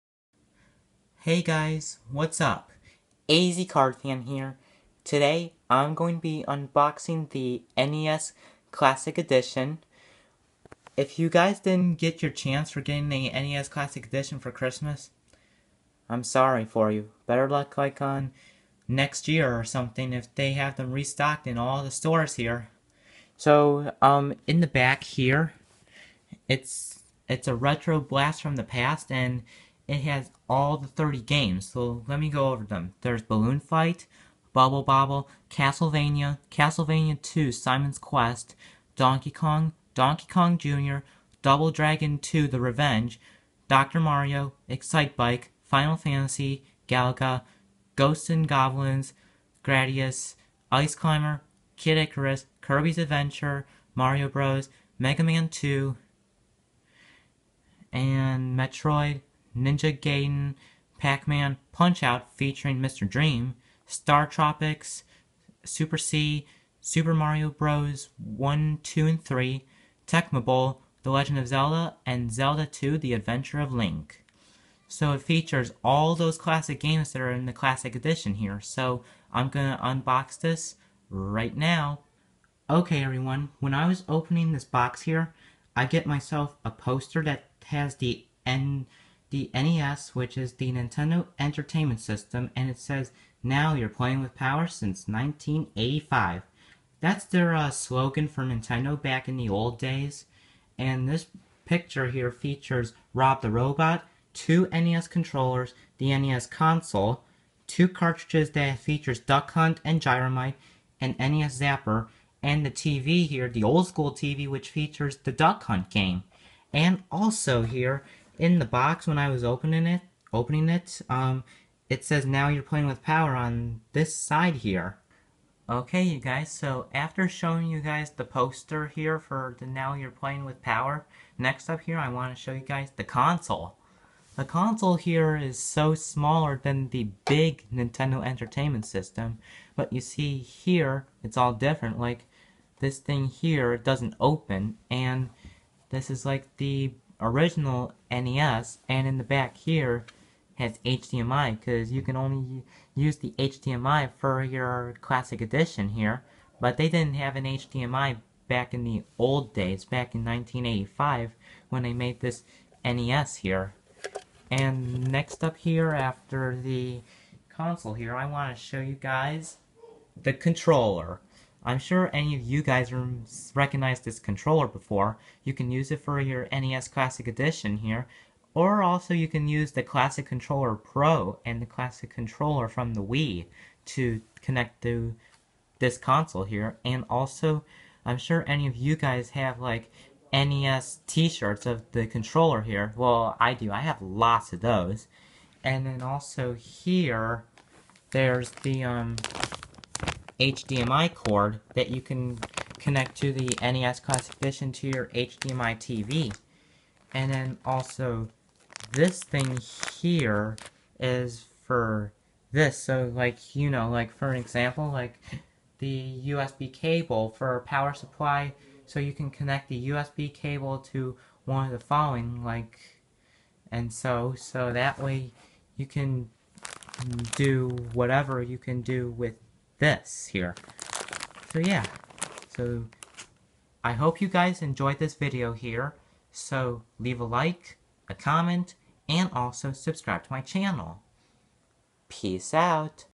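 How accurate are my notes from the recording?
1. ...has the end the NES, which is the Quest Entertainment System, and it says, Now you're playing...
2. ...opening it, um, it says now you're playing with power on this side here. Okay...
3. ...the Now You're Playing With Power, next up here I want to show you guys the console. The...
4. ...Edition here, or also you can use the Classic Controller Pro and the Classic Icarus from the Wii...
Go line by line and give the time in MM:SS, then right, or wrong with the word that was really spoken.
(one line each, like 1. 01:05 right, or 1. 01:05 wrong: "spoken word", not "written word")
1. 01:27 wrong: "Nintendo", not "Quest"
2. 02:00 right
3. 02:09 right
4. 02:57 wrong: "Controller", not "Icarus".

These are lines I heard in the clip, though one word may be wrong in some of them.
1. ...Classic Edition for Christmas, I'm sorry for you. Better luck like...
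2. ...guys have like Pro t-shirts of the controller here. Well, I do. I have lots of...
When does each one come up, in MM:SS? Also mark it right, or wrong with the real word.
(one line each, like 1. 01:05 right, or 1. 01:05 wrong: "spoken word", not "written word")
1. 00:13 right
2. 03:08 wrong: "NES", not "Pro".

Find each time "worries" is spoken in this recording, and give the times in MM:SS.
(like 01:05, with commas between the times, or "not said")
not said.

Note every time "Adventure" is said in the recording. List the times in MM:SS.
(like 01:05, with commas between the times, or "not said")
00:52, 01:13.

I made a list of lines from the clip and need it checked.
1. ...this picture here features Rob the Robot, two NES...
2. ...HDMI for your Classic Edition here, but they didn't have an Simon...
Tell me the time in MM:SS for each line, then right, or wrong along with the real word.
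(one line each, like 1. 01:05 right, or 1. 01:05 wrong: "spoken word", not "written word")
1. 01:41 right
2. 02:33 wrong: "HDMI", not "Simon".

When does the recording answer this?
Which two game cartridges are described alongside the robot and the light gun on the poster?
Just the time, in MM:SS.
01:49.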